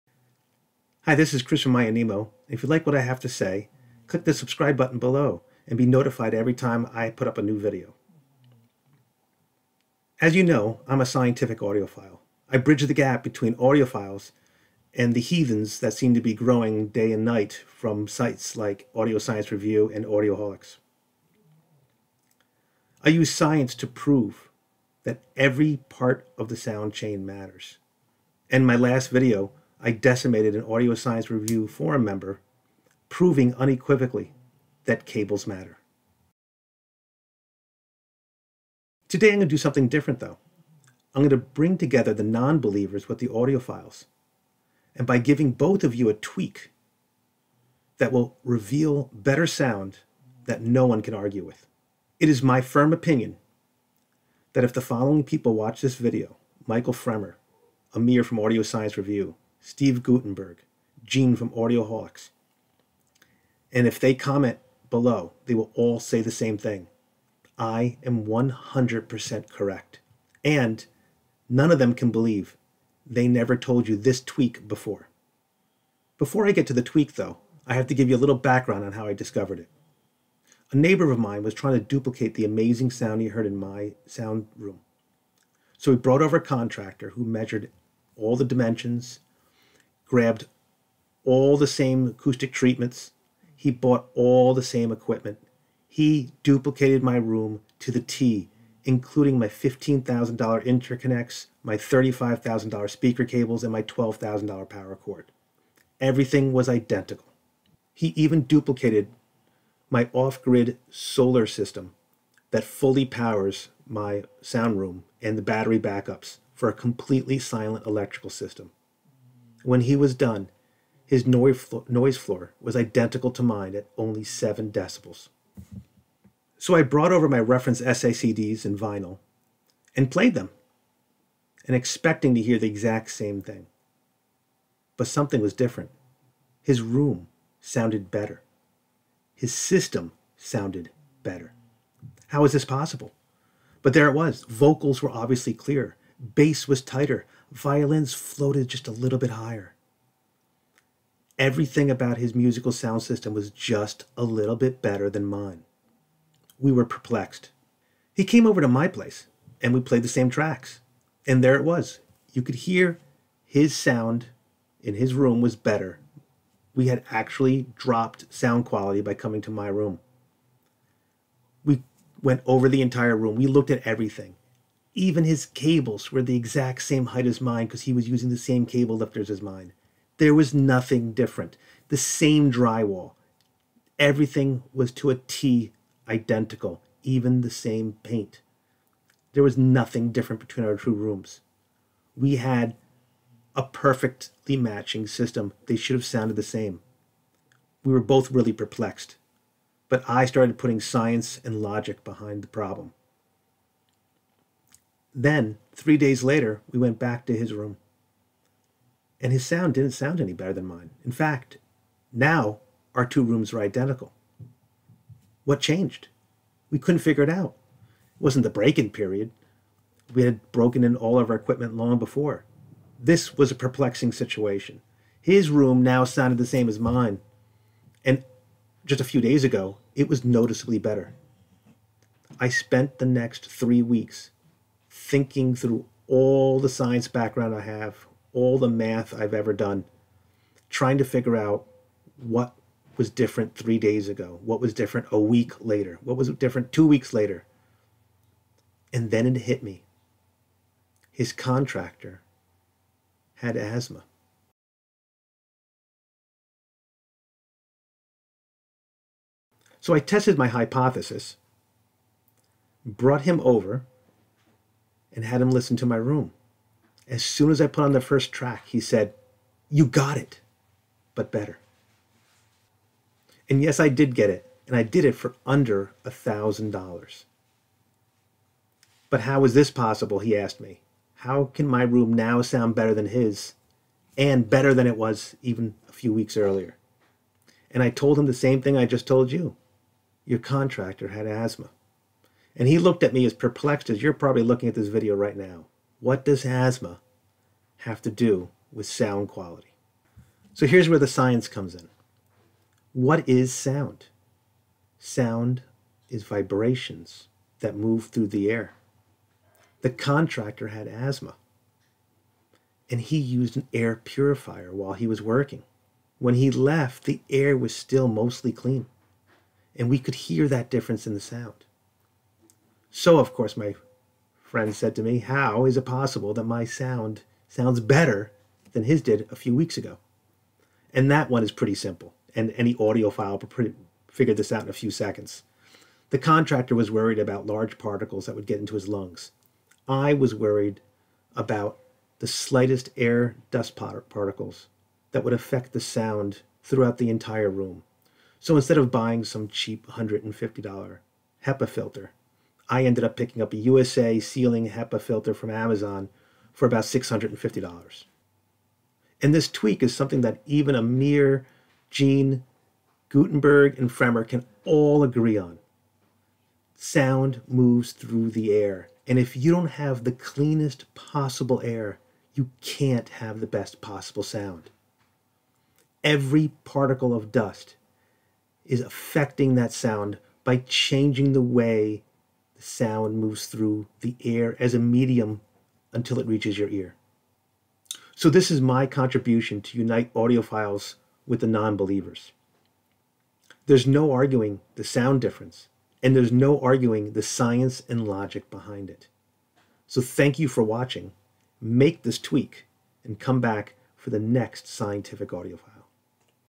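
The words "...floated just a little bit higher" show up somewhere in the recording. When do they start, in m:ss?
2:28.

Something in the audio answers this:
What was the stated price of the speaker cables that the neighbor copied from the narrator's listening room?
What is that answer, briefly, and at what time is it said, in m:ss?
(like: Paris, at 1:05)
$35,000, at 1:41.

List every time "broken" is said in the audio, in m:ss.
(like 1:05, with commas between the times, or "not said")
3:40.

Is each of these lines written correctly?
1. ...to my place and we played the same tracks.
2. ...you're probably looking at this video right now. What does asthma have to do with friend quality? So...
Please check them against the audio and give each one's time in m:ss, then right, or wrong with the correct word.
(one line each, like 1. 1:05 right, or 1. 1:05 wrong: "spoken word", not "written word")
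1. 2:38 right
2. 4:54 wrong: "sound", not "friend".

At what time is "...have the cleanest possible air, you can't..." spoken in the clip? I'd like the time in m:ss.
6:09.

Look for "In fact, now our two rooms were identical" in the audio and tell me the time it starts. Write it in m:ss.
3:31.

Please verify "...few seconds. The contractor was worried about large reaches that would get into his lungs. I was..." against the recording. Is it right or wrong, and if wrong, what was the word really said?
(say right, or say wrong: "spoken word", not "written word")
wrong: "particles", not "reaches".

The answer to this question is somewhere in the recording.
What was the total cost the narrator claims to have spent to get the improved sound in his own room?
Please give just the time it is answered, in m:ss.
4:35.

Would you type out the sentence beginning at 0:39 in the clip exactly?
Today I'm going to do something different though.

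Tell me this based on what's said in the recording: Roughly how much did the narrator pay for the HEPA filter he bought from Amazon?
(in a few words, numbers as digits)
$650.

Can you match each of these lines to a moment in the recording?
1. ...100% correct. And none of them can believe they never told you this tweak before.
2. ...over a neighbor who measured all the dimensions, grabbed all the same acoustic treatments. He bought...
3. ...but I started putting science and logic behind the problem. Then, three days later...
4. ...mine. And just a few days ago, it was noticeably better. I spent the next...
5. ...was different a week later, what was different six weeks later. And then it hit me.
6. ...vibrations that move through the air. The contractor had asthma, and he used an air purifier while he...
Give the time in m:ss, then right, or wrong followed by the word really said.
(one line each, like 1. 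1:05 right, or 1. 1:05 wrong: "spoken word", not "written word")
1. 1:08 right
2. 1:26 wrong: "contractor", not "neighbor"
3. 3:19 right
4. 3:46 right
5. 4:04 wrong: "two", not "six"
6. 5:06 right.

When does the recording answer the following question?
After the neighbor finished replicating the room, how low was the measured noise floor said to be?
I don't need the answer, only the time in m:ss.
2:04.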